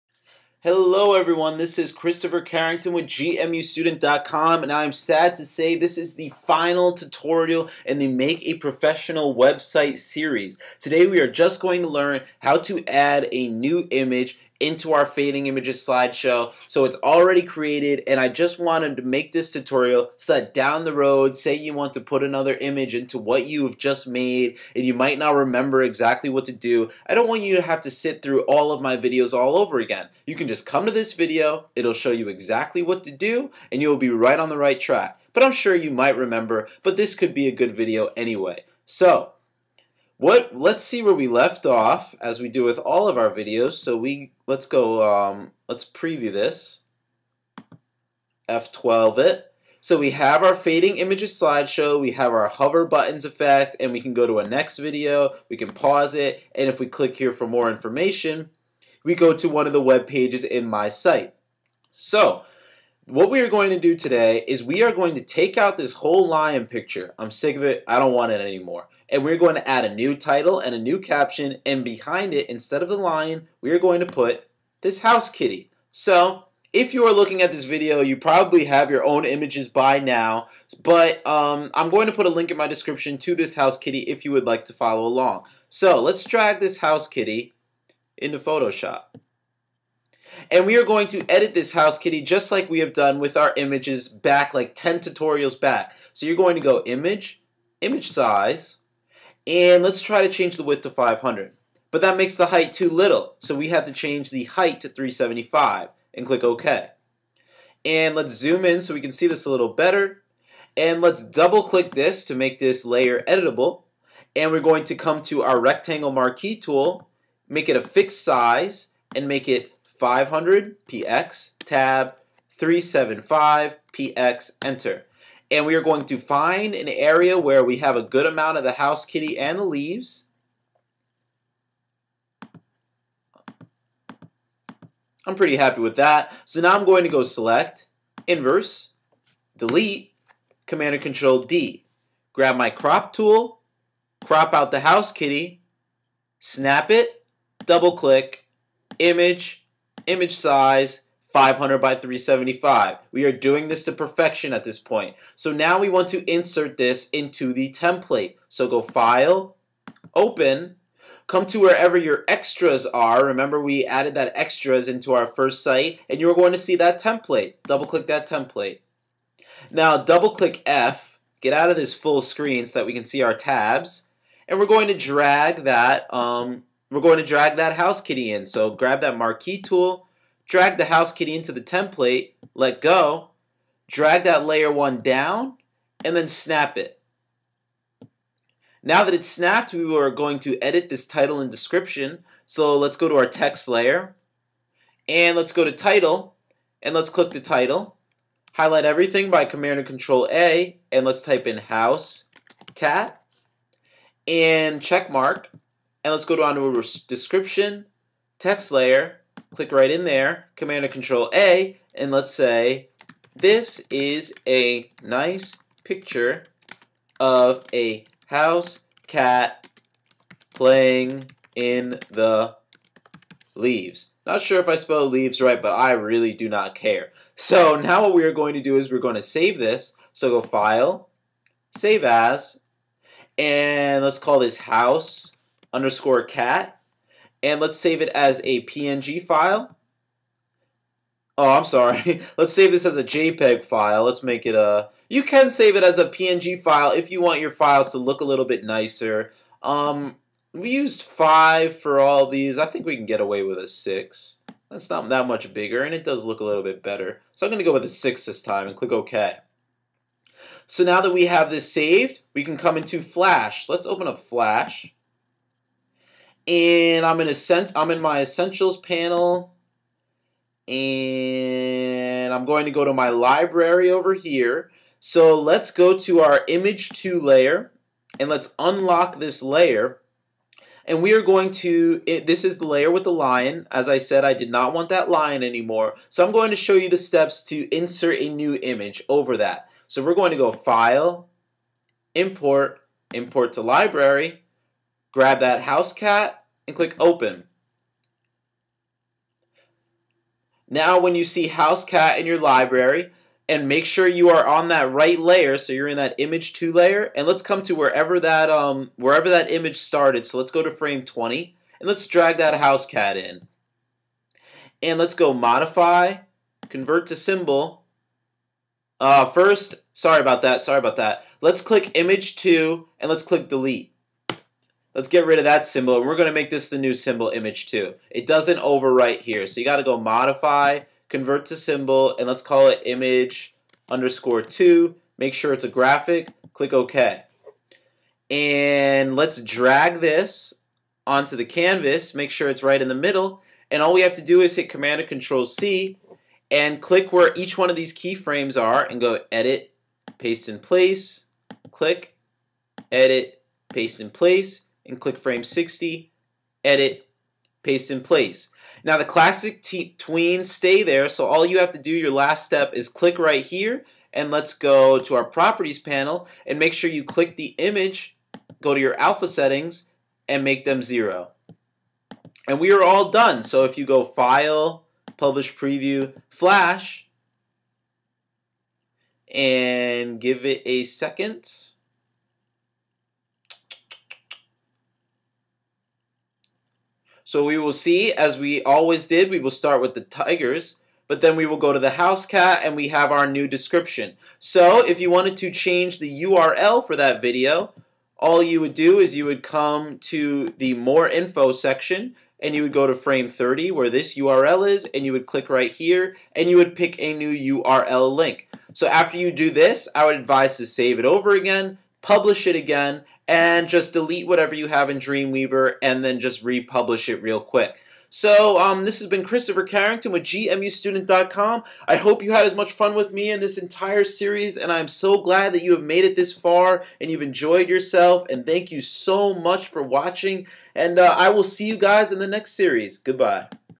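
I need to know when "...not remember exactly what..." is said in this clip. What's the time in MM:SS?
00:25.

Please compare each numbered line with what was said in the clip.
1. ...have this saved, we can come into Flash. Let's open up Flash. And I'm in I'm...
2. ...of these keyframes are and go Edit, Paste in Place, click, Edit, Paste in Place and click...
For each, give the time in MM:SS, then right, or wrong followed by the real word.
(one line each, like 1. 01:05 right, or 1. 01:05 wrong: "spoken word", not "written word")
1. 04:21 right
2. 05:47 right.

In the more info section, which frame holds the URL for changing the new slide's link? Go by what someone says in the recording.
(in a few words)
30.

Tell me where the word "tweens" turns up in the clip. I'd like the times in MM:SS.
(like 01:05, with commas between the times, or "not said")
05:59.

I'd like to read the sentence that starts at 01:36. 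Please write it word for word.
So you're going to go image, image size, and let's try to change the width to 500.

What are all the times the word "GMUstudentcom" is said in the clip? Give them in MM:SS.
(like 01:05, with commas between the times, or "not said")
00:03, 07:00.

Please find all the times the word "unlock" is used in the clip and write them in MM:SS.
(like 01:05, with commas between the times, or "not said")
04:38.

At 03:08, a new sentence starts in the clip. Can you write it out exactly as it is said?
Now that it's snapped, we are going to edit this title and description.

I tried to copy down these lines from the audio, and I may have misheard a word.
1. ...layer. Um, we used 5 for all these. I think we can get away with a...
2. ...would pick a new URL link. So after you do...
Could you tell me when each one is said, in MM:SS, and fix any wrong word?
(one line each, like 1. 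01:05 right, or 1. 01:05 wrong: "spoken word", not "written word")
1. 04:08 wrong: "nicer", not "layer"
2. 06:46 right.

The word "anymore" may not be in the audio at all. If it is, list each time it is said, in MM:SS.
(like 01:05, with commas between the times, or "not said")
01:08, 04:45.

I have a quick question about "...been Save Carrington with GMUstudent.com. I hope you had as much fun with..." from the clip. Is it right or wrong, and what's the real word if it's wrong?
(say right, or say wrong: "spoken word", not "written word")
wrong: "Christopher", not "Save".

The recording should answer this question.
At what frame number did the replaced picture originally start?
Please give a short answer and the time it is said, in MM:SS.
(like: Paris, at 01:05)
20, at 05:10.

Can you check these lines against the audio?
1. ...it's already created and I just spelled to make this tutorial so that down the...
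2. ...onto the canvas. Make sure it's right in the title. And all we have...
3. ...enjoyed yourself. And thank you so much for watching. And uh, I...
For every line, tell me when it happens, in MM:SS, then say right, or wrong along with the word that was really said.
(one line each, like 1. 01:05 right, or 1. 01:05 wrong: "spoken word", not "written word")
1. 00:16 wrong: "wanted", not "spelled"
2. 05:41 wrong: "middle", not "title"
3. 07:07 right.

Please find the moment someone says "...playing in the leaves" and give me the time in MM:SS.
03:40.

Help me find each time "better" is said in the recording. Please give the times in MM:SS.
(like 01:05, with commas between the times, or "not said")
01:49, 04:16.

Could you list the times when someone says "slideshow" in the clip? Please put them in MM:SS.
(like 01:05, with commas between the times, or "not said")
00:15, 00:51.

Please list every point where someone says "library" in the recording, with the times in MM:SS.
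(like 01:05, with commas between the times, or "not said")
04:33, 04:53, 05:02.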